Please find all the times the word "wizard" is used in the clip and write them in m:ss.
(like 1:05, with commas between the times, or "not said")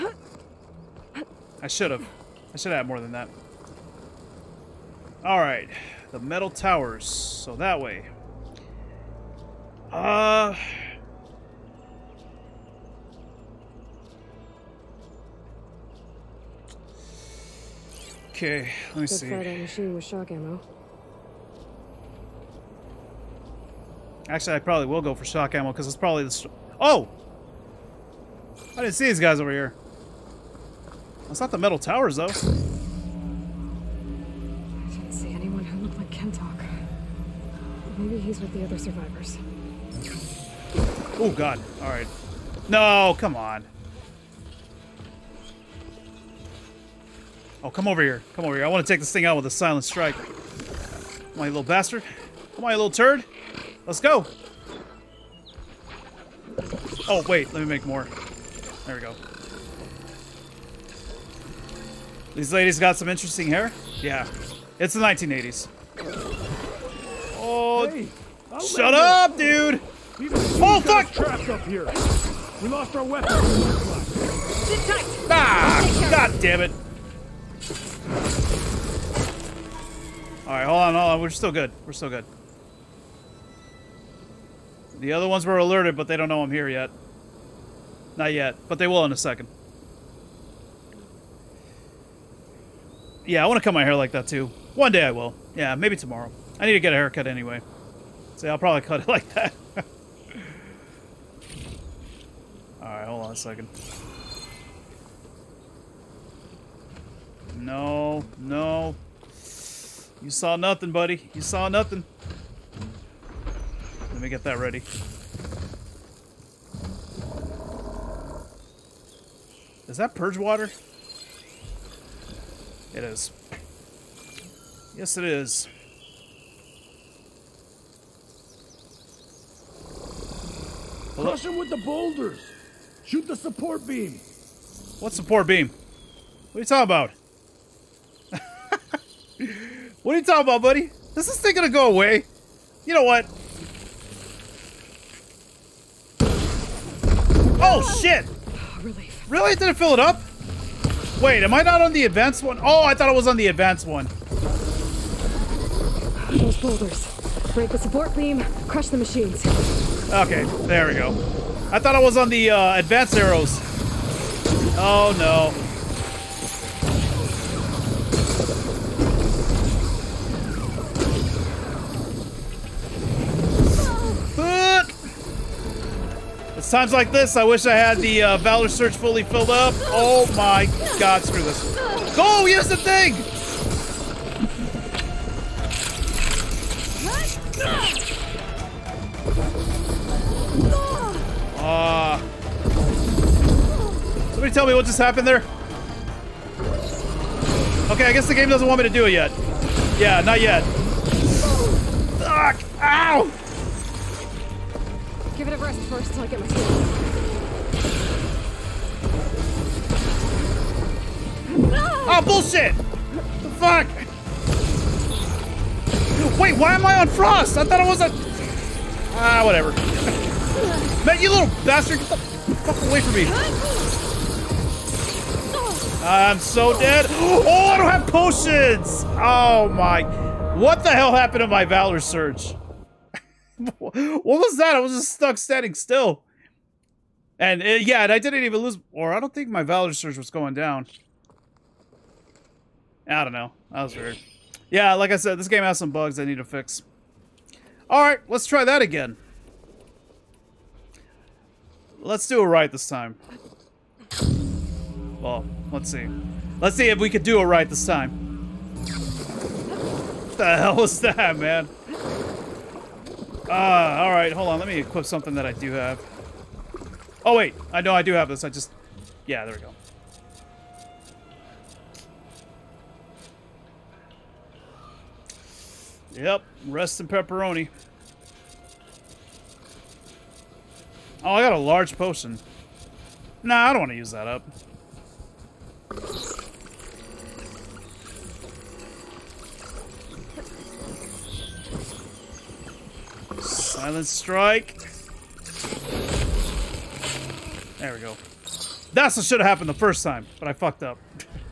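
not said.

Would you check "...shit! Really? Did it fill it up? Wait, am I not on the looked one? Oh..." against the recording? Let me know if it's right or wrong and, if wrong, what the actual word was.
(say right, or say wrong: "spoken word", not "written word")
wrong: "advanced", not "looked".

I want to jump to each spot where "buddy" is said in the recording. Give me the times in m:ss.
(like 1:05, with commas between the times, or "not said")
1:50, 2:20.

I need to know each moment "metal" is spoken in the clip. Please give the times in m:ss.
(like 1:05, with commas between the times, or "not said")
0:06, 0:31.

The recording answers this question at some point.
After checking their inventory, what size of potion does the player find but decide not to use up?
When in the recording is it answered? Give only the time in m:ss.
4:41.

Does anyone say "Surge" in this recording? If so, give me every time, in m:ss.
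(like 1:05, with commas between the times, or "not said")
2:58, 3:51, 3:59.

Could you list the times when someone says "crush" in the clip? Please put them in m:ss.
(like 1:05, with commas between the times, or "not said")
2:11, 2:38.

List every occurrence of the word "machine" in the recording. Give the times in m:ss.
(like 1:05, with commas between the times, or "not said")
0:19, 2:38.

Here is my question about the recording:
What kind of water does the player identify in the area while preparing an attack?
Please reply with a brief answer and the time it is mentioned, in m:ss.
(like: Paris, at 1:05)
Purge water, at 2:00.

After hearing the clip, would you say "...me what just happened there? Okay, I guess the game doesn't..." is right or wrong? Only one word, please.
right.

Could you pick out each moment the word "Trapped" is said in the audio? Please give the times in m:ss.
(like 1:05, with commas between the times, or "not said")
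1:11.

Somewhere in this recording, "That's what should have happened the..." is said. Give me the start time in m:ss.
4:58.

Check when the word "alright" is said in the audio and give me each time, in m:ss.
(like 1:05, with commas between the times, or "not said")
0:05, 1:20, 1:42, 4:07, 4:24.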